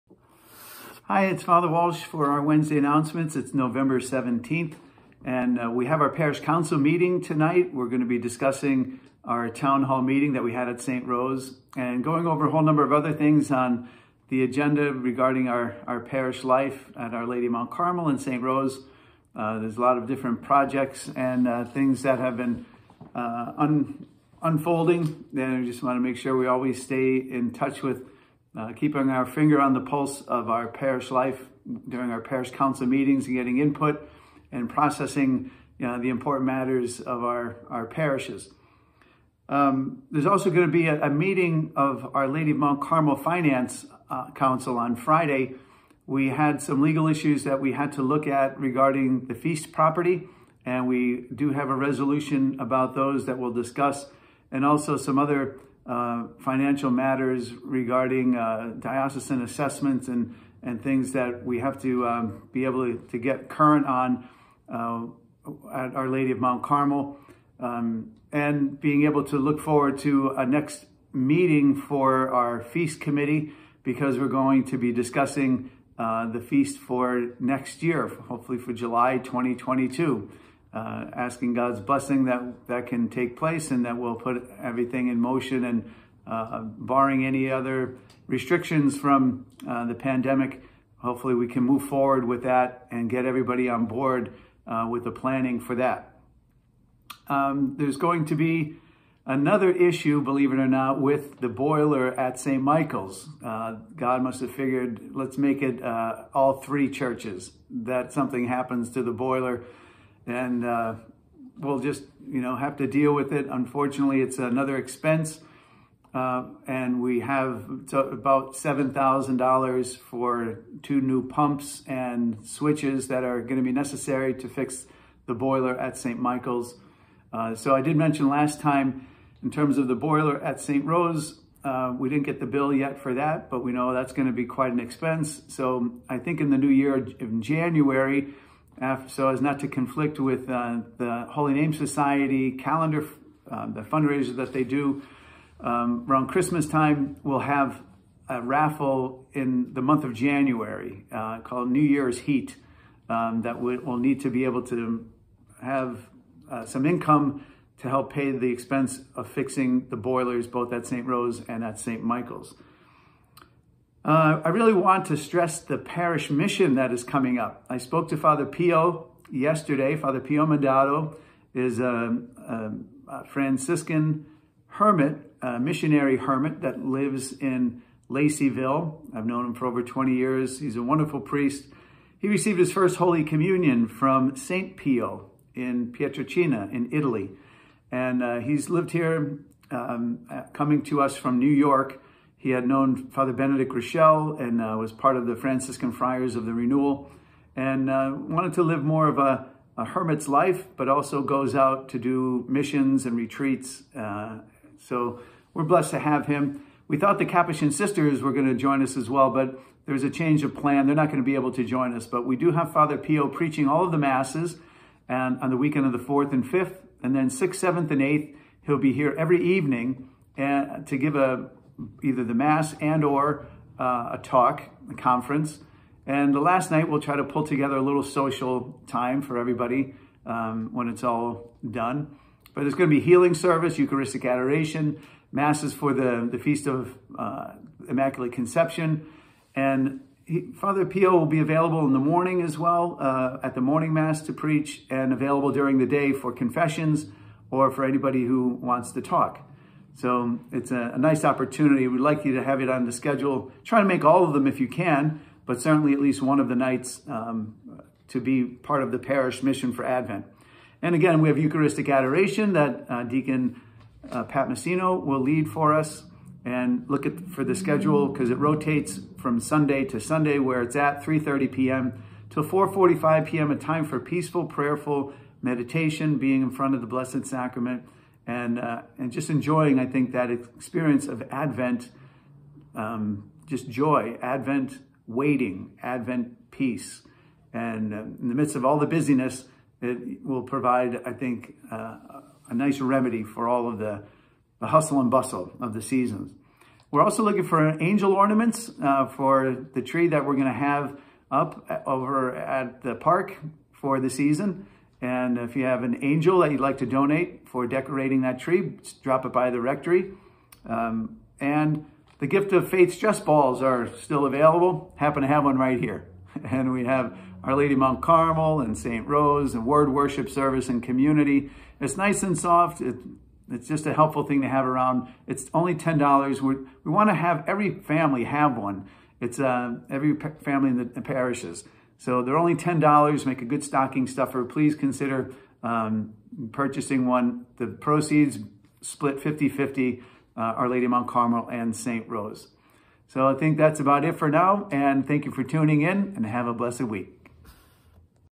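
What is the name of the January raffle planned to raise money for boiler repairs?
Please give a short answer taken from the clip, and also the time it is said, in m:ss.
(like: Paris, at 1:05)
New Year's Heat, at 2:31.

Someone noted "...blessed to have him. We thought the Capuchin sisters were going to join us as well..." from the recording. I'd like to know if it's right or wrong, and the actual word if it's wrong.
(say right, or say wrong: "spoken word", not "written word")
right.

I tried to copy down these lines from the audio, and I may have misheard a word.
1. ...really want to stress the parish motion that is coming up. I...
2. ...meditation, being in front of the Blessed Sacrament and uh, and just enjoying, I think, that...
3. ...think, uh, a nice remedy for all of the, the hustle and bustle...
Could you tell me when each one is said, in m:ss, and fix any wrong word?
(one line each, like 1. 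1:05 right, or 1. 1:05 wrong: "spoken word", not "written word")
1. 2:44 wrong: "mission", not "motion"
2. 4:35 right
3. 4:51 right.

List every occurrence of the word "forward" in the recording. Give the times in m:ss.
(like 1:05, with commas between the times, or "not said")
1:09, 1:31.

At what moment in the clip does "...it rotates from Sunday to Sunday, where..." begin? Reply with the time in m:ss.
4:28.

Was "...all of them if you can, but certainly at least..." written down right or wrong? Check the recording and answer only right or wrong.
right.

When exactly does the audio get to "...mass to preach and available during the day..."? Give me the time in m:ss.
4:03.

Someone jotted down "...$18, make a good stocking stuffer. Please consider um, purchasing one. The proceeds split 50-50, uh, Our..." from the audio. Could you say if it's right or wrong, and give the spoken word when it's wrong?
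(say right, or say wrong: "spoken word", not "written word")
wrong: "10", not "18".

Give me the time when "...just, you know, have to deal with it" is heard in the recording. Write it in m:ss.
1:51.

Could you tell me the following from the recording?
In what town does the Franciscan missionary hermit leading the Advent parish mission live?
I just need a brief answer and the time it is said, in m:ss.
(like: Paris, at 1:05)
Laceyville, at 2:58.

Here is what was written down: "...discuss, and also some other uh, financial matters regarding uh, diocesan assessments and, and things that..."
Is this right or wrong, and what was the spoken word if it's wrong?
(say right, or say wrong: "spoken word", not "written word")
right.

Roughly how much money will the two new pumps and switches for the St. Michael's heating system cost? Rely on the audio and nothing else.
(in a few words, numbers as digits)
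$7,000.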